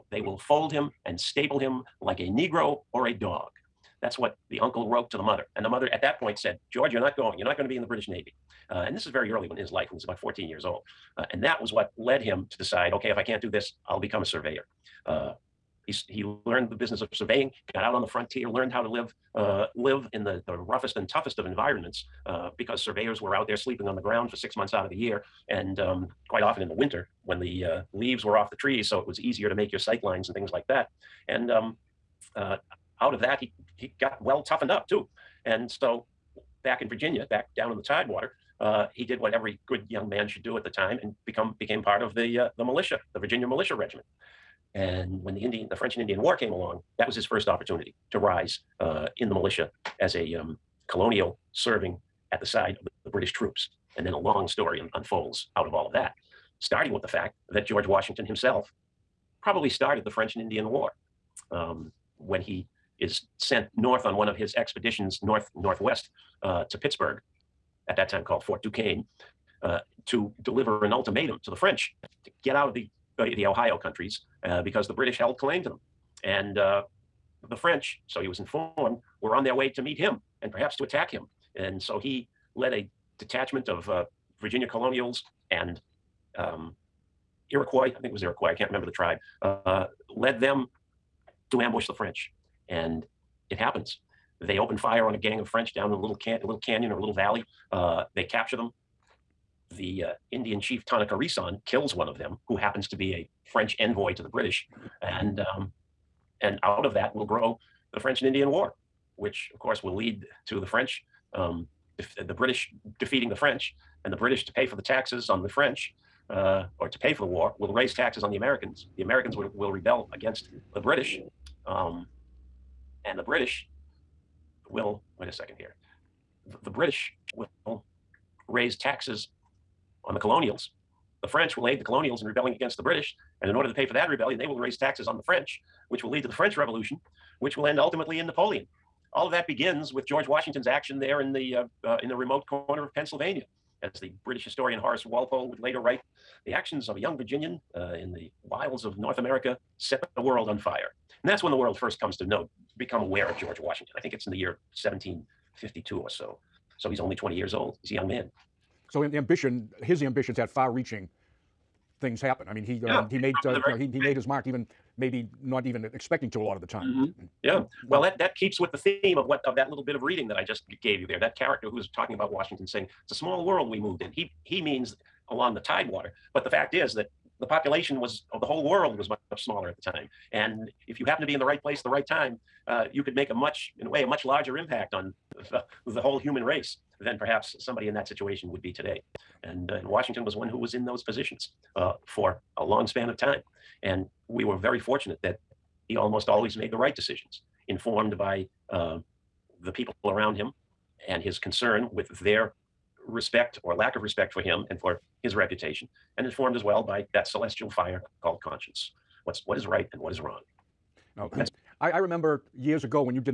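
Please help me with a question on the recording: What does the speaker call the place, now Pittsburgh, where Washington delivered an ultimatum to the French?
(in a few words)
Fort Duquesne.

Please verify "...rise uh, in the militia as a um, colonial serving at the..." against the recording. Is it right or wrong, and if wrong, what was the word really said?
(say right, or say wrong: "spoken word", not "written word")
right.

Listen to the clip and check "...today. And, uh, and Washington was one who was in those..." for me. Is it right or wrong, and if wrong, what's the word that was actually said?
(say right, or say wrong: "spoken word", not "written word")
right.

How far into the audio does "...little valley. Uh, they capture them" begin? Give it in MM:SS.
01:37.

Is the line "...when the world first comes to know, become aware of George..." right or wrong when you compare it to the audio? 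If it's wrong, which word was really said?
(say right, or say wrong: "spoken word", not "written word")
right.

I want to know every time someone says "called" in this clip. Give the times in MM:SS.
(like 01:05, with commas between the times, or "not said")
01:08, 03:28.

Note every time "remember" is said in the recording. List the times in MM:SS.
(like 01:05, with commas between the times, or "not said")
01:28, 03:31.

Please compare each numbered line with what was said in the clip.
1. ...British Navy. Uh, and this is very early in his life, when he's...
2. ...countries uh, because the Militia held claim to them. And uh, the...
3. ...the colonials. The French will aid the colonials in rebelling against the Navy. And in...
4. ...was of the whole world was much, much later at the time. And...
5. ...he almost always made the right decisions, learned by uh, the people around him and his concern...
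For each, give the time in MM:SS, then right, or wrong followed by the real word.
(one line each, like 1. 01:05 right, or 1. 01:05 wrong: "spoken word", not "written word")
1. 00:07 right
2. 01:13 wrong: "British", not "Militia"
3. 02:10 wrong: "British", not "Navy"
4. 02:57 wrong: "smaller", not "later"
5. 03:15 wrong: "informed", not "learned".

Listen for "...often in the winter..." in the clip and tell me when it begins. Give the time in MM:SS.
00:26.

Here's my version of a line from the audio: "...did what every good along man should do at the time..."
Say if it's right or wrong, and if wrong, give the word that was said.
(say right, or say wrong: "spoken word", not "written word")
wrong: "young", not "along".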